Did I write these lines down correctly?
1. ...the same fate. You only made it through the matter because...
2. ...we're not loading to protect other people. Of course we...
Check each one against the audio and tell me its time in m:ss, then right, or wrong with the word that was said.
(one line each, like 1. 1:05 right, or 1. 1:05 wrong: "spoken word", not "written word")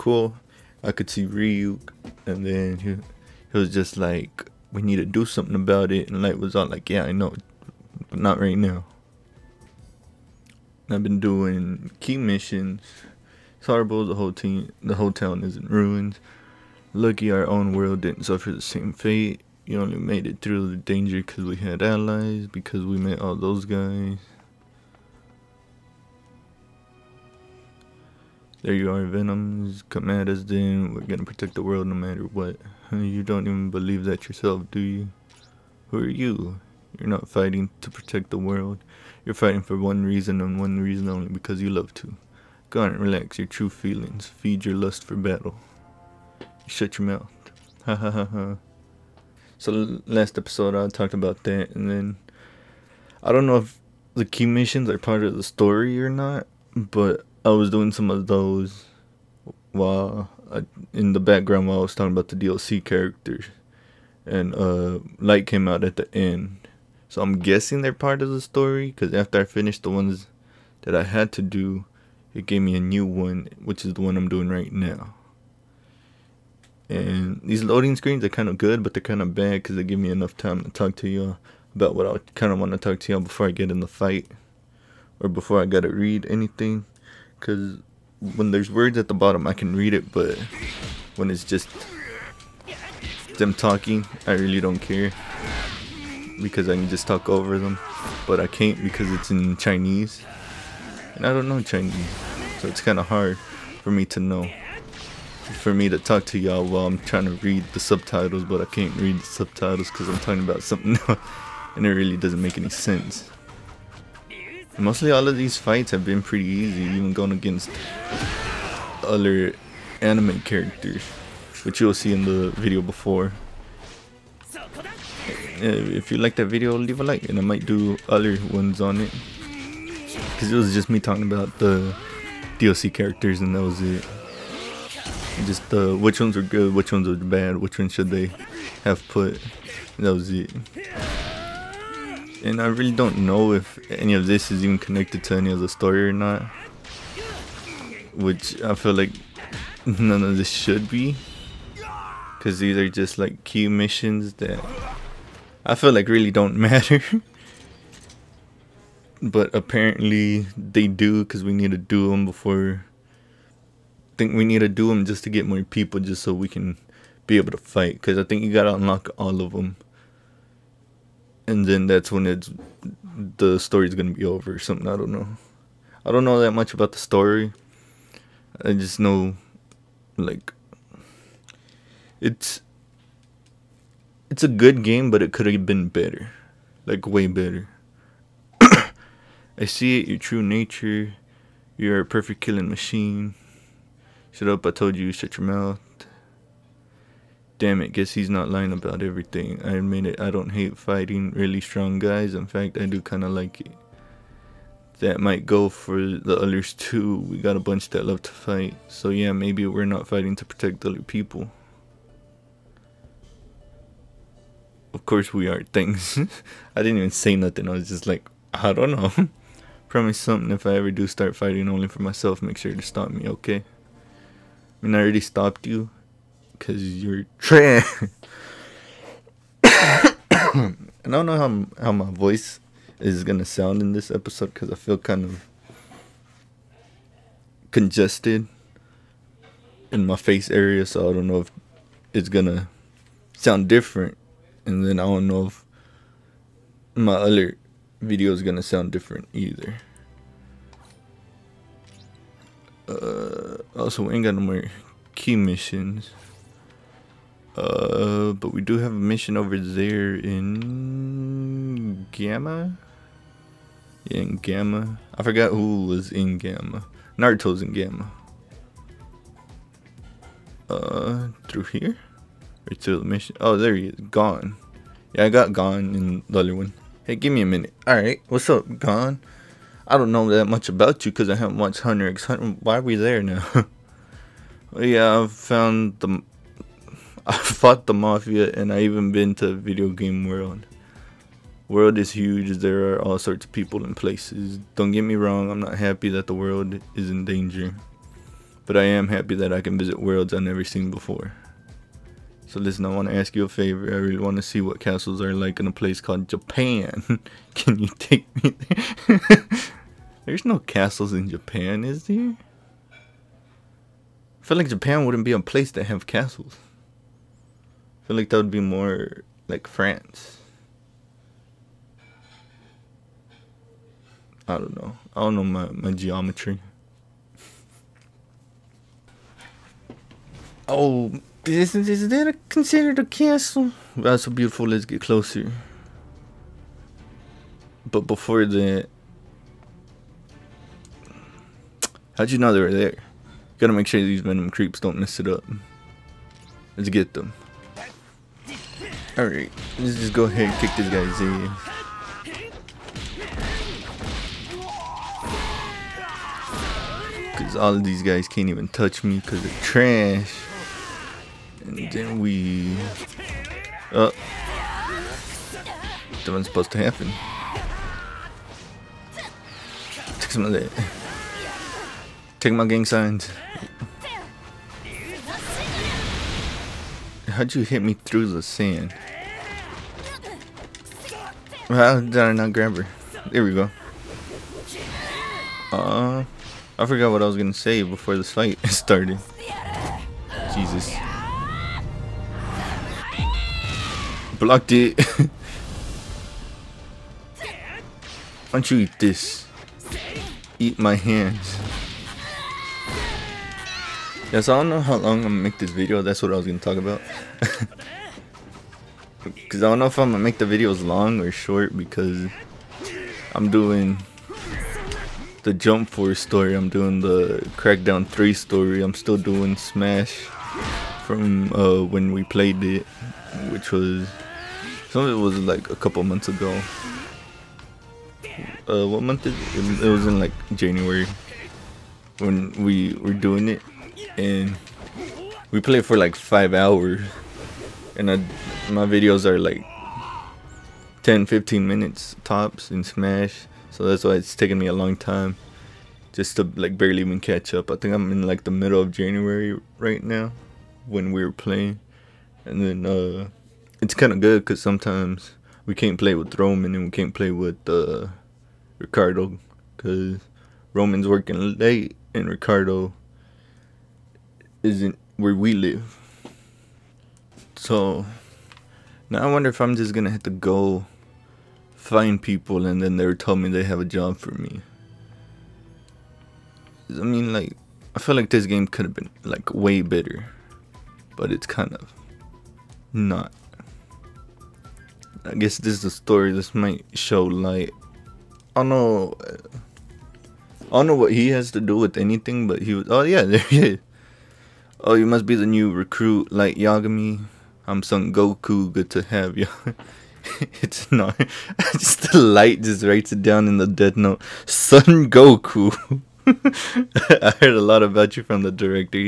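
1. 0:18 wrong: "danger", not "matter"
2. 3:29 wrong: "fighting", not "loading".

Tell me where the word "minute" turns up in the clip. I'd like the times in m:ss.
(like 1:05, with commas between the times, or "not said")
4:37, 7:21.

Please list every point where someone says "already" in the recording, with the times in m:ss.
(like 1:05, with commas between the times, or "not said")
3:45.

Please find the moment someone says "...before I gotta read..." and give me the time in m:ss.
1:25.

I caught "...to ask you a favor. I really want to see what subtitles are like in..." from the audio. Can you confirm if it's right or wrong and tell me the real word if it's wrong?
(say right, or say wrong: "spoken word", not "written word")
wrong: "castles", not "subtitles".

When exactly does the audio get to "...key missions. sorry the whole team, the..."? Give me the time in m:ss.
0:12.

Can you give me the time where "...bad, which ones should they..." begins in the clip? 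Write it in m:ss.
2:17.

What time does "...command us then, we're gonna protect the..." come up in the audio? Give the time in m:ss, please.
0:29.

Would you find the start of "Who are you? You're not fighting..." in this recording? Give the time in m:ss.
0:35.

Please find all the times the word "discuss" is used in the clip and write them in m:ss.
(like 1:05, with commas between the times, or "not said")
not said.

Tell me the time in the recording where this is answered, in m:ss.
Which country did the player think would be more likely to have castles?
5:19.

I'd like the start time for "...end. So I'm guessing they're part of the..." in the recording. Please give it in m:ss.
1:06.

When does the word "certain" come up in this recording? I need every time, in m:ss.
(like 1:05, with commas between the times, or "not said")
not said.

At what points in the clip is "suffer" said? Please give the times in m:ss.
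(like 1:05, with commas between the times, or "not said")
0:18.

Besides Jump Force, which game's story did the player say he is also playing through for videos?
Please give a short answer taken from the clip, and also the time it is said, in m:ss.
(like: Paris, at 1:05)
Crackdown 3, at 6:57.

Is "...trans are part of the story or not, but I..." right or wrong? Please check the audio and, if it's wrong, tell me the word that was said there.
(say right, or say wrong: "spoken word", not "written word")
wrong: "missions", not "trans".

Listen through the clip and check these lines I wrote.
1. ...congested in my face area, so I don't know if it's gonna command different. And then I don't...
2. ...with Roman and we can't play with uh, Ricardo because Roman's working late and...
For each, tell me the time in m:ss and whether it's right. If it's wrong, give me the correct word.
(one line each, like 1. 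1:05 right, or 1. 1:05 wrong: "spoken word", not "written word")
1. 3:57 wrong: "sound", not "command"
2. 7:36 right.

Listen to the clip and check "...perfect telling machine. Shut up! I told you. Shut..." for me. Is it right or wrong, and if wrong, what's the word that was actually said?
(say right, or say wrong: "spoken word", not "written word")
wrong: "killing", not "telling".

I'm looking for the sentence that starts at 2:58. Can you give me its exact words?
I just know, like, it's it's a good game, but it could have been better, like way better.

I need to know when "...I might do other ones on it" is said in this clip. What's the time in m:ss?
2:07.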